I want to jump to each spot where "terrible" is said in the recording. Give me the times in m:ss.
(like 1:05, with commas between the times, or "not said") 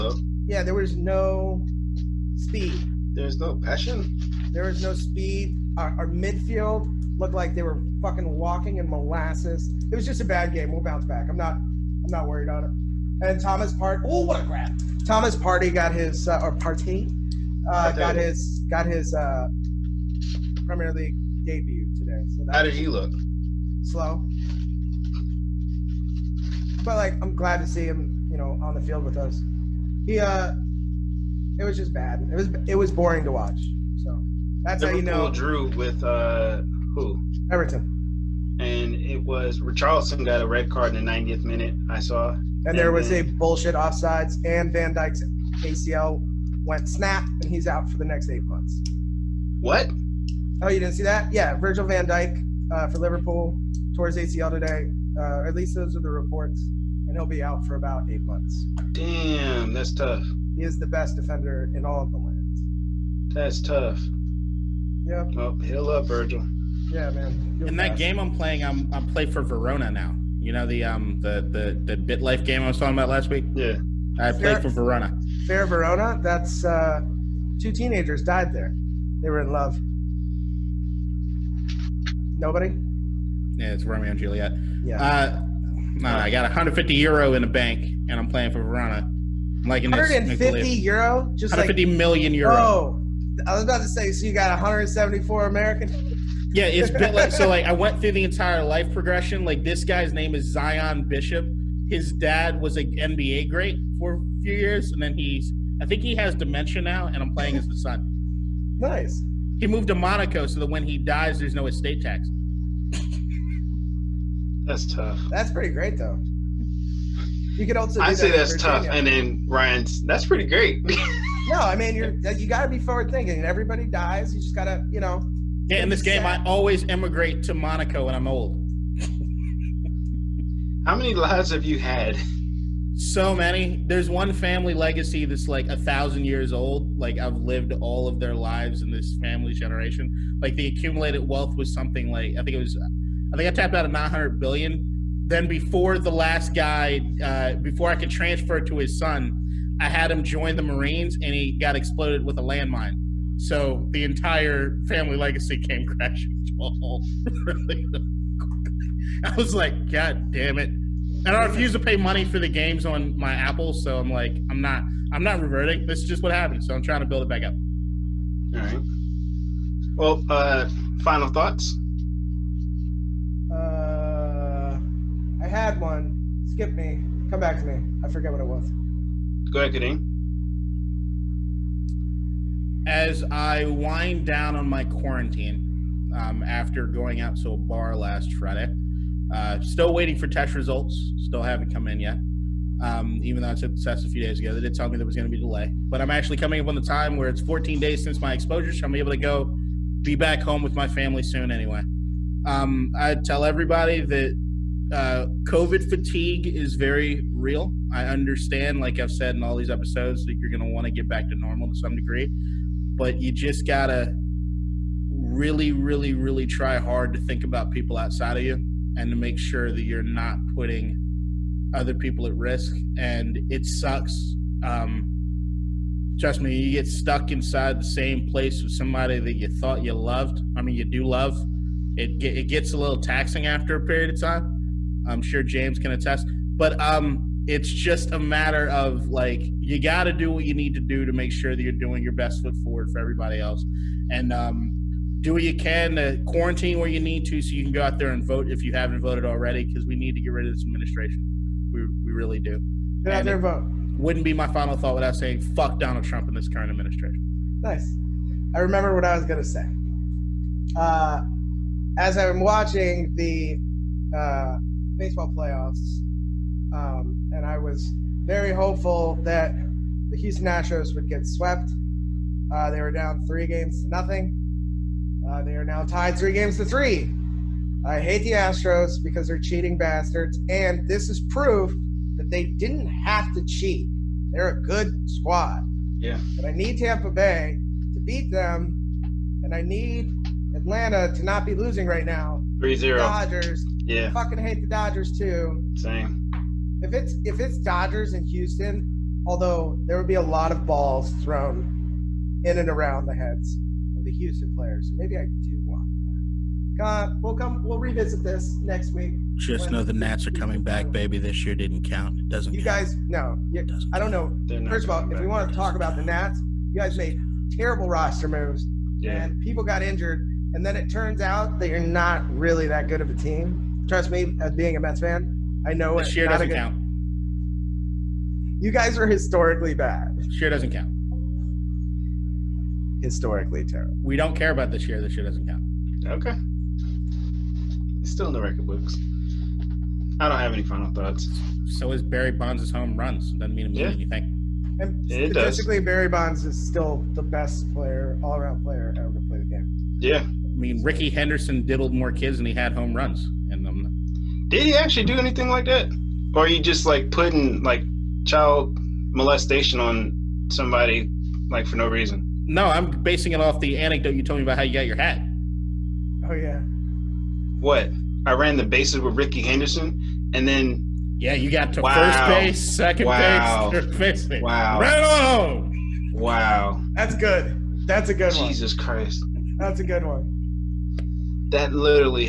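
5:17, 5:33.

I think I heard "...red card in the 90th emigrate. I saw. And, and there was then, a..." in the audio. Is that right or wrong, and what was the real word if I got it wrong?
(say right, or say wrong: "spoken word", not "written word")
wrong: "minute", not "emigrate".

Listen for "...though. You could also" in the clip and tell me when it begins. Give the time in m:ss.
1:55.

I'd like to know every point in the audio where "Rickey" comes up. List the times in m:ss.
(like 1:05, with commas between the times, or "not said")
5:50, 6:09.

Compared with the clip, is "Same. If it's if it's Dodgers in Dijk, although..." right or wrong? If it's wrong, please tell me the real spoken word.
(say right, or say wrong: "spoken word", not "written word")
wrong: "Houston", not "Dijk".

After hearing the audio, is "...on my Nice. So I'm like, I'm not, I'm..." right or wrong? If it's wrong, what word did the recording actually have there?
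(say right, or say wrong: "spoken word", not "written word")
wrong: "Apple", not "Nice".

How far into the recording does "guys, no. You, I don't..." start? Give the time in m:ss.
5:12.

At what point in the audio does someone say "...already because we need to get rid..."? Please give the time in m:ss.
4:09.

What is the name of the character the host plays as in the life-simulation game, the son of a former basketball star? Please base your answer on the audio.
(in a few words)
Zion Bishop.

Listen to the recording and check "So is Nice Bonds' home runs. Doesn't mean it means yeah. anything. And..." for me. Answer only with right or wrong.
wrong.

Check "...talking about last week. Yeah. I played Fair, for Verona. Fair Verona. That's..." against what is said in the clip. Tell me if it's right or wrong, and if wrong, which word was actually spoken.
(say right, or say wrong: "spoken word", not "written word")
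right.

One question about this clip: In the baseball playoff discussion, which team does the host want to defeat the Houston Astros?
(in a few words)
Tampa Bay.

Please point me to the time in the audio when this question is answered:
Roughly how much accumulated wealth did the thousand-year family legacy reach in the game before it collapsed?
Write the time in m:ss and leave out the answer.
2:23.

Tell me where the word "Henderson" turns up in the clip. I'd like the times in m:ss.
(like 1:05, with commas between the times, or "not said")
5:51, 6:09.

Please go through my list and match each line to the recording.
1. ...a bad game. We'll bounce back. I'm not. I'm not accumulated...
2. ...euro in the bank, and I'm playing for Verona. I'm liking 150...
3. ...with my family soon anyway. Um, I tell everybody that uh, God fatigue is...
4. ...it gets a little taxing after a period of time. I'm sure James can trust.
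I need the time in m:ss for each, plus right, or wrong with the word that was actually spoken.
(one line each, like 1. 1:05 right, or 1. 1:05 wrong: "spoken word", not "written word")
1. 0:10 wrong: "worried", not "accumulated"
2. 1:26 right
3. 3:20 wrong: "COVID", not "God"
4. 3:52 wrong: "attest", not "trust".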